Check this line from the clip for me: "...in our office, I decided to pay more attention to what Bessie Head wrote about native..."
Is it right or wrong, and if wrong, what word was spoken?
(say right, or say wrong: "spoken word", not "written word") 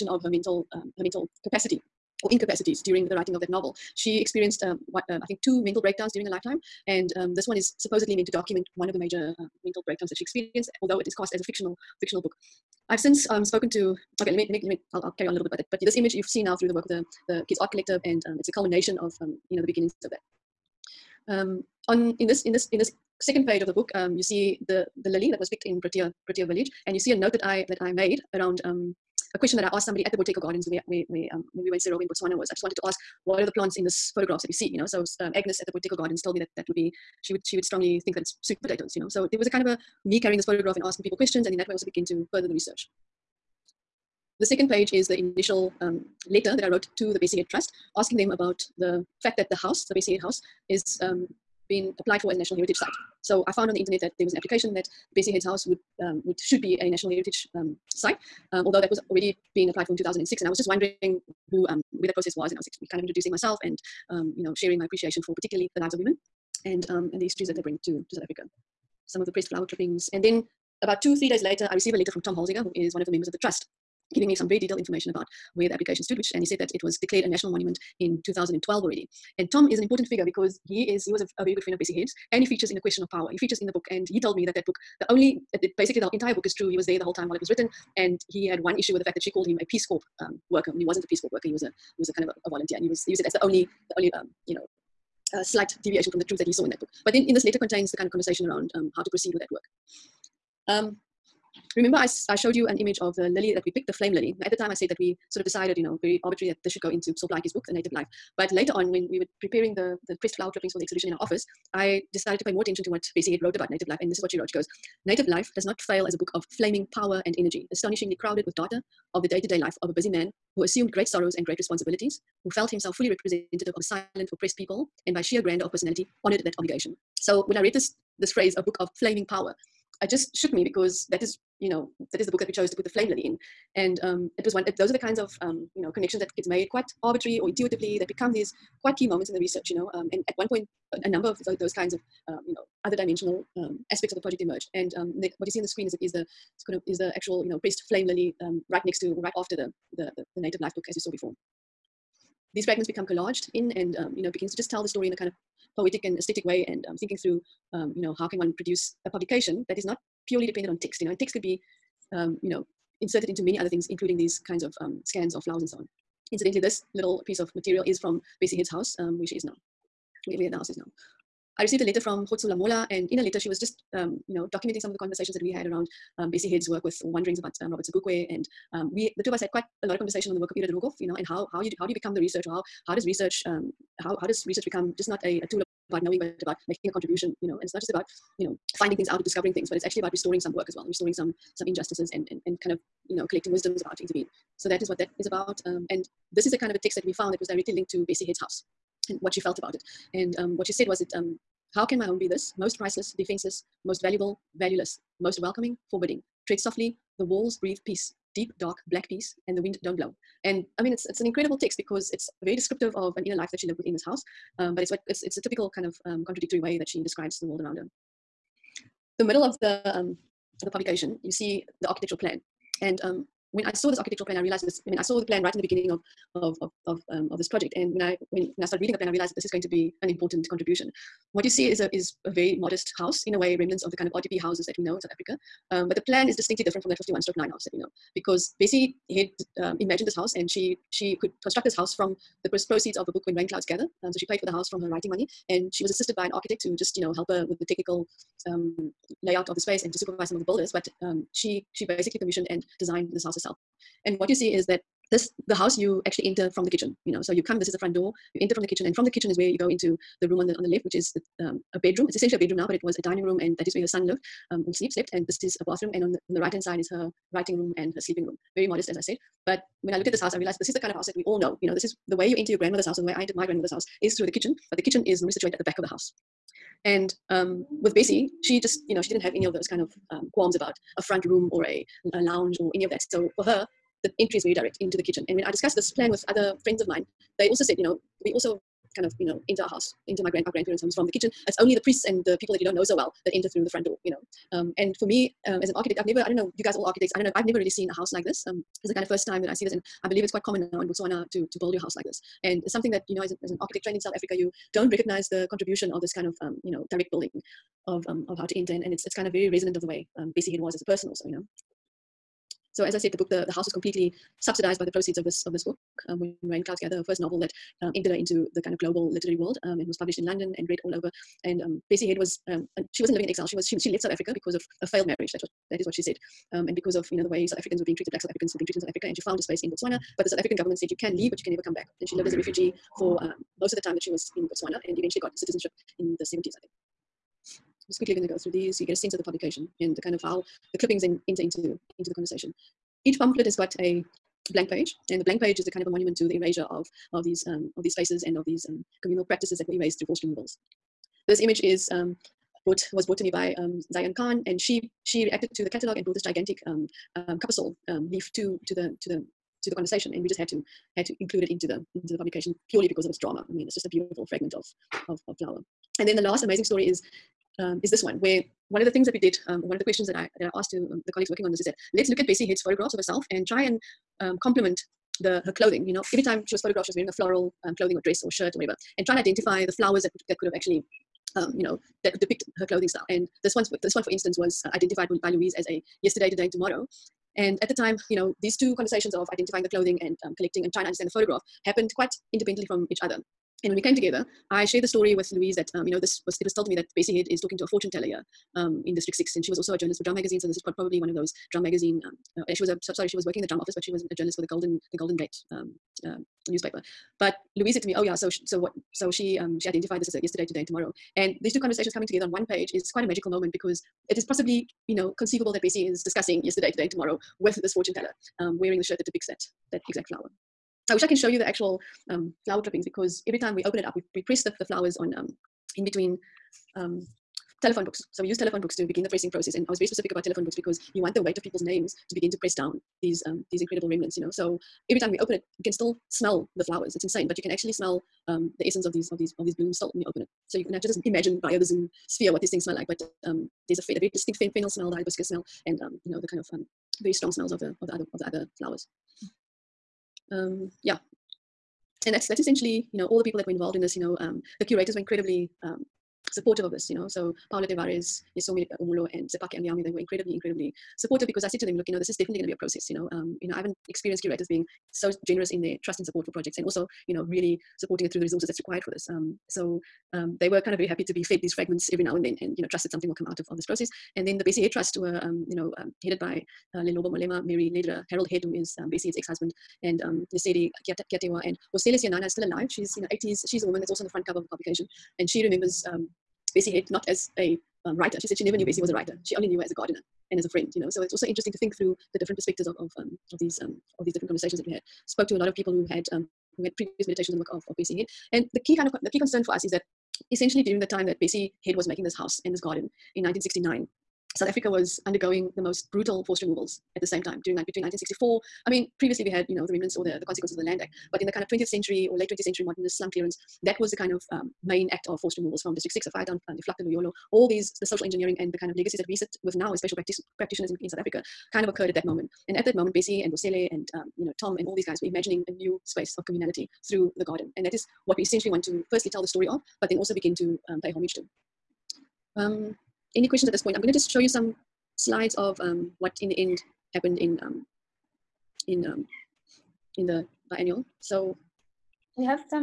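right.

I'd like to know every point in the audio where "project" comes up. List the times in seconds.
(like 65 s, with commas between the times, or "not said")
144 s, 227 s, 466 s.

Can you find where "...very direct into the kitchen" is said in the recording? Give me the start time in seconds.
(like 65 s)
284 s.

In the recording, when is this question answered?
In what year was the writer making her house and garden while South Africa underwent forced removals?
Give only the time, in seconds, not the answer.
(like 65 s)
503 s.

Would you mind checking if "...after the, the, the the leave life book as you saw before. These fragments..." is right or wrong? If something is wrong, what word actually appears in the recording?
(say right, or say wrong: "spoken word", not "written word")
wrong: "native", not "leave".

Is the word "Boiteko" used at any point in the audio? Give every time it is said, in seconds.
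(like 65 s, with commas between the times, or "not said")
30 s, 35 s.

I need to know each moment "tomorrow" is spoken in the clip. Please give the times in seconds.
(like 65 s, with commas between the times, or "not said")
386 s, 410 s, 416 s.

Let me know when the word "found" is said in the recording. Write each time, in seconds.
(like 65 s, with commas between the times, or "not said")
53 s, 197 s, 329 s.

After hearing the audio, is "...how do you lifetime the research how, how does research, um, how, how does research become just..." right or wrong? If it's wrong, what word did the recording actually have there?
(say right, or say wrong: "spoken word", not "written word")
wrong: "become", not "lifetime".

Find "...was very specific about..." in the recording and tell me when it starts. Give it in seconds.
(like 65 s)
429 s.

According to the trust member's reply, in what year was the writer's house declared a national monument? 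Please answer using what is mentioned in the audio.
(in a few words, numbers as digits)
2012.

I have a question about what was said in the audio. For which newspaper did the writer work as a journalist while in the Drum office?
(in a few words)
Golden Gate.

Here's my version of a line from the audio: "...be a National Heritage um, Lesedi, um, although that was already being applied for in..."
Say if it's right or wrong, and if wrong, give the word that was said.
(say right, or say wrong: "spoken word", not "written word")
wrong: "Site", not "Lesedi".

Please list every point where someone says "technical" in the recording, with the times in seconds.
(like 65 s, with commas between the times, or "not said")
247 s.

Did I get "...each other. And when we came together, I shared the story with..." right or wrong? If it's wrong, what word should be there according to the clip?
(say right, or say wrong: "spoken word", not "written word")
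right.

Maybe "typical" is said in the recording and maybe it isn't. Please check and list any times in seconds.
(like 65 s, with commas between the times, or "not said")
215 s.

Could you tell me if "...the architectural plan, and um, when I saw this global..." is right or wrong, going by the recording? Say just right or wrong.
wrong.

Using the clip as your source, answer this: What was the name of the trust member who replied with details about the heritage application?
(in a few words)
Tom Holzinger.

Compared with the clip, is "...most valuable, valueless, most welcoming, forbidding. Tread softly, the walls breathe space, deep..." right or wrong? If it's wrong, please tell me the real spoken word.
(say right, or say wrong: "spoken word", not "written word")
wrong: "peace", not "space".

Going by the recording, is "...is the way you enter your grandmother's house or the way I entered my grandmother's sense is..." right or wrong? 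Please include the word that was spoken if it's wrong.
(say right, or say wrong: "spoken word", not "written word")
wrong: "house", not "sense".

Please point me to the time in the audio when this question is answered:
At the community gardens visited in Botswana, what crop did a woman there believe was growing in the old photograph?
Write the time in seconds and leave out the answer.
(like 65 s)
38 s.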